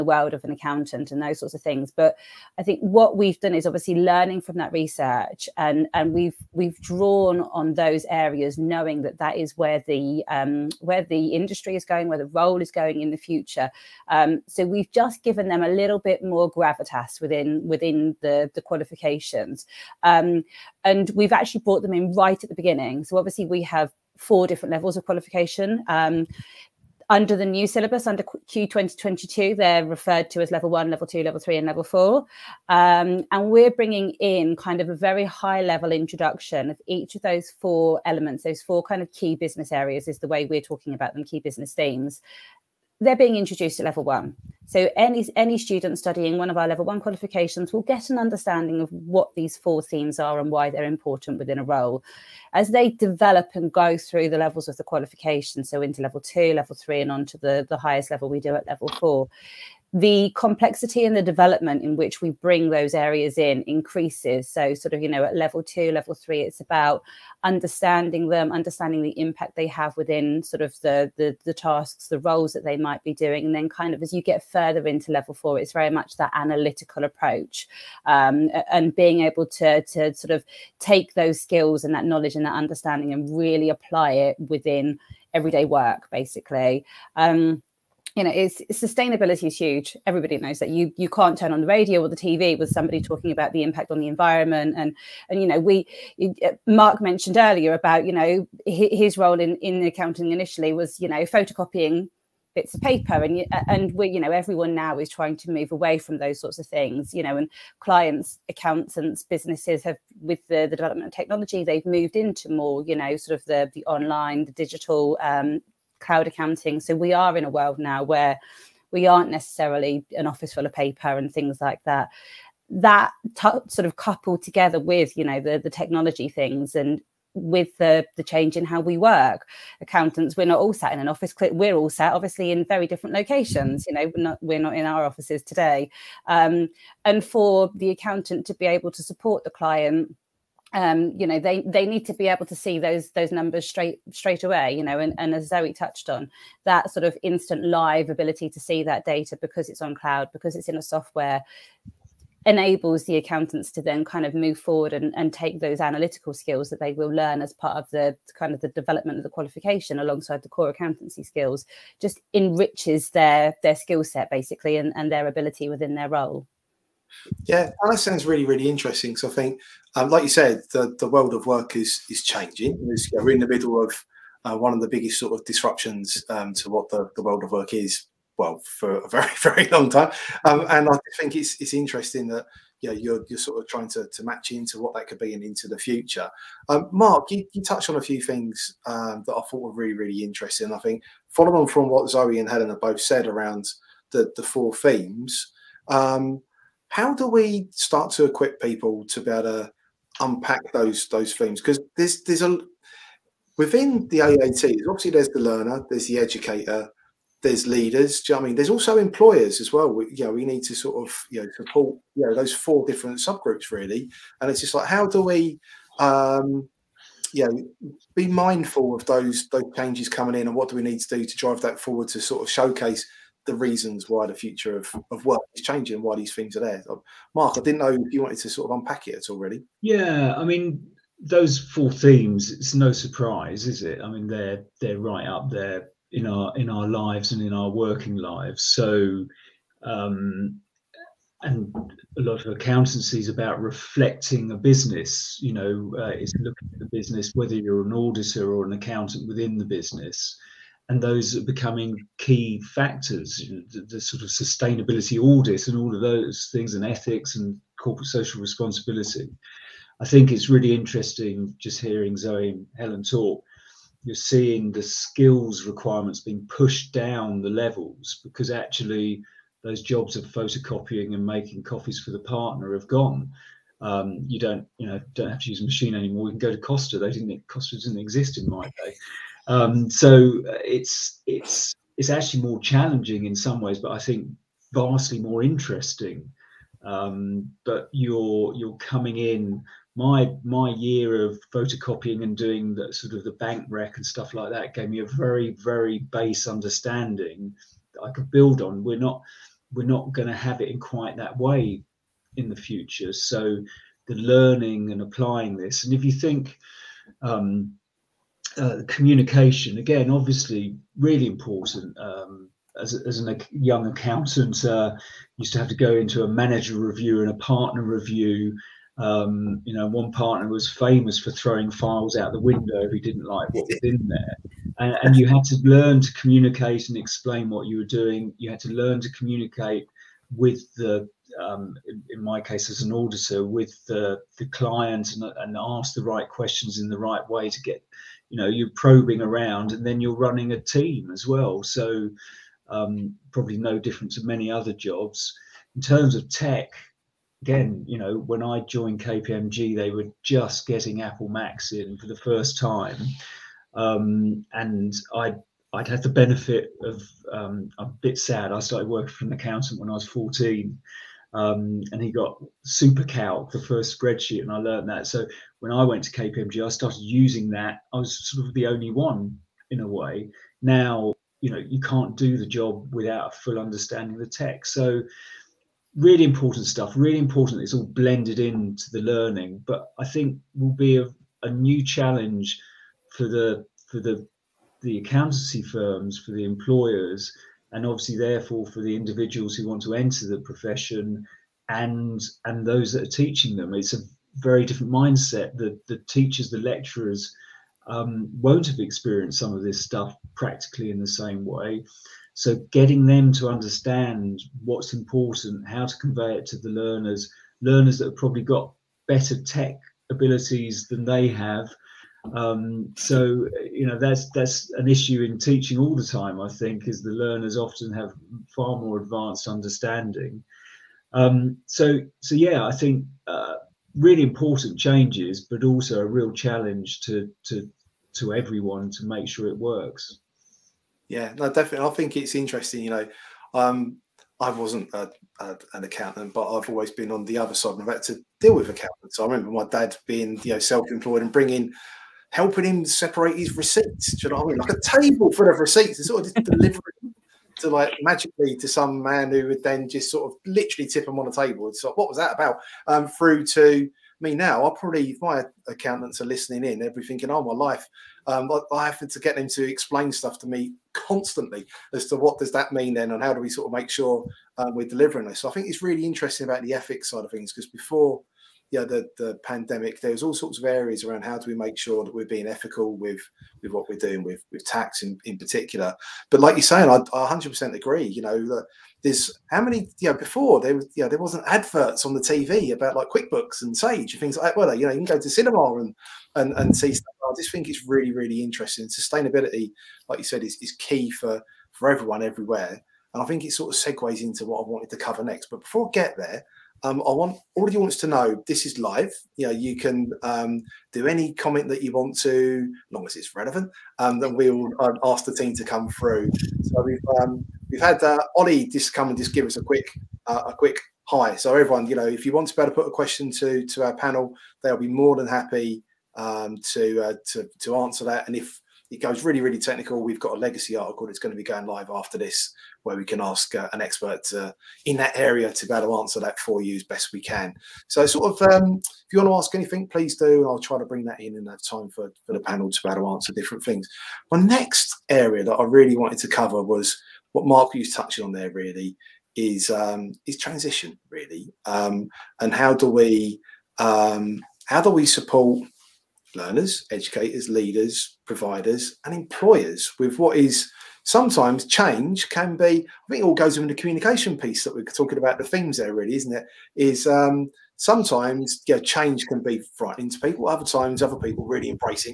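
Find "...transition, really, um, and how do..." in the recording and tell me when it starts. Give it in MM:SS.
09:00.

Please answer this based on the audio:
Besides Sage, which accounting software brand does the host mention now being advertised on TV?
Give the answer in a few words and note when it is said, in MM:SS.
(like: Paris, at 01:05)
QuickBooks, at 08:03.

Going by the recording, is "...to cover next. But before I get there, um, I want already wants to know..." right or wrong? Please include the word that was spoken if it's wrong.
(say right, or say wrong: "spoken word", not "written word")
right.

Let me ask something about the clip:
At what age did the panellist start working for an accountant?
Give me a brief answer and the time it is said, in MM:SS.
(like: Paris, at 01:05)
14, at 06:00.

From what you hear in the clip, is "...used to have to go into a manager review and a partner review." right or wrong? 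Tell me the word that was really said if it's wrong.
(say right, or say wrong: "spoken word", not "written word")
right.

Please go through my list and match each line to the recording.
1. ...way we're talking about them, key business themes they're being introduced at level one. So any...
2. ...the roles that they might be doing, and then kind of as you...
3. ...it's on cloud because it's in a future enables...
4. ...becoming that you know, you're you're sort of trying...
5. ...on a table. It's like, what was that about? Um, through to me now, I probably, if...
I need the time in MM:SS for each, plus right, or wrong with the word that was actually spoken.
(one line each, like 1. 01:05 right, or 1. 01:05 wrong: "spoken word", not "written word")
1. 00:40 right
2. 01:12 right
3. 02:29 wrong: "software", not "future"
4. 03:01 wrong: "interesting", not "becoming"
5. 07:31 right.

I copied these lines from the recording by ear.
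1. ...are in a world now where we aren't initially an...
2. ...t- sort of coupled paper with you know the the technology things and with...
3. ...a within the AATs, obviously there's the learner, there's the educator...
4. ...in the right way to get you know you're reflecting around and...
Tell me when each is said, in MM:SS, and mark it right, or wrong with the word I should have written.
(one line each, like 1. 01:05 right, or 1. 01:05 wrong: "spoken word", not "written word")
1. 01:57 wrong: "necessarily", not "initially"
2. 02:03 wrong: "together", not "paper"
3. 03:22 right
4. 05:36 wrong: "probing", not "reflecting".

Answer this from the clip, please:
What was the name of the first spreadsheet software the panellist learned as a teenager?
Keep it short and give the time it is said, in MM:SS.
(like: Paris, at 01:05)
SuperCalc, at 06:02.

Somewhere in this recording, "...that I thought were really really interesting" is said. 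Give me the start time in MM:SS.
03:09.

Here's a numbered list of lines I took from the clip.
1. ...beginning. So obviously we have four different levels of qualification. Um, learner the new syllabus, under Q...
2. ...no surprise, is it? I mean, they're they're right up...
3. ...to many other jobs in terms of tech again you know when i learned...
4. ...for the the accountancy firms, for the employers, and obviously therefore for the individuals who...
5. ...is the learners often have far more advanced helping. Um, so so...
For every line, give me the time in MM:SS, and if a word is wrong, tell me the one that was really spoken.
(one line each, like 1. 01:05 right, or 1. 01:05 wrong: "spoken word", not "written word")
1. 00:22 wrong: "under", not "learner"
2. 03:52 right
3. 05:44 wrong: "joined", not "learned"
4. 06:23 right
5. 06:56 wrong: "understanding", not "helping".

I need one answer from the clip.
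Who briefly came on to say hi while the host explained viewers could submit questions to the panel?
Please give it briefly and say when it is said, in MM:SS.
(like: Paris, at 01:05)
Ollie, at 08:28.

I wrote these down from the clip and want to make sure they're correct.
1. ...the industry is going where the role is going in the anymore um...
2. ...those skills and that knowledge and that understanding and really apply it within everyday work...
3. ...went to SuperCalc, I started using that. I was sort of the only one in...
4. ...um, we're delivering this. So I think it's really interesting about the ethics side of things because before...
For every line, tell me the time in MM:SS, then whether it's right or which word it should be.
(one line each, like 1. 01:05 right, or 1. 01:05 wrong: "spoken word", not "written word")
1. 00:11 wrong: "future", not "anymore"
2. 01:21 right
3. 06:05 wrong: "KPMG", not "SuperCalc"
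4. 07:44 right.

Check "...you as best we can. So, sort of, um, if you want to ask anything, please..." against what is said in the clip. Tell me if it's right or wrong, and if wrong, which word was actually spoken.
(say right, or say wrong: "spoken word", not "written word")
right.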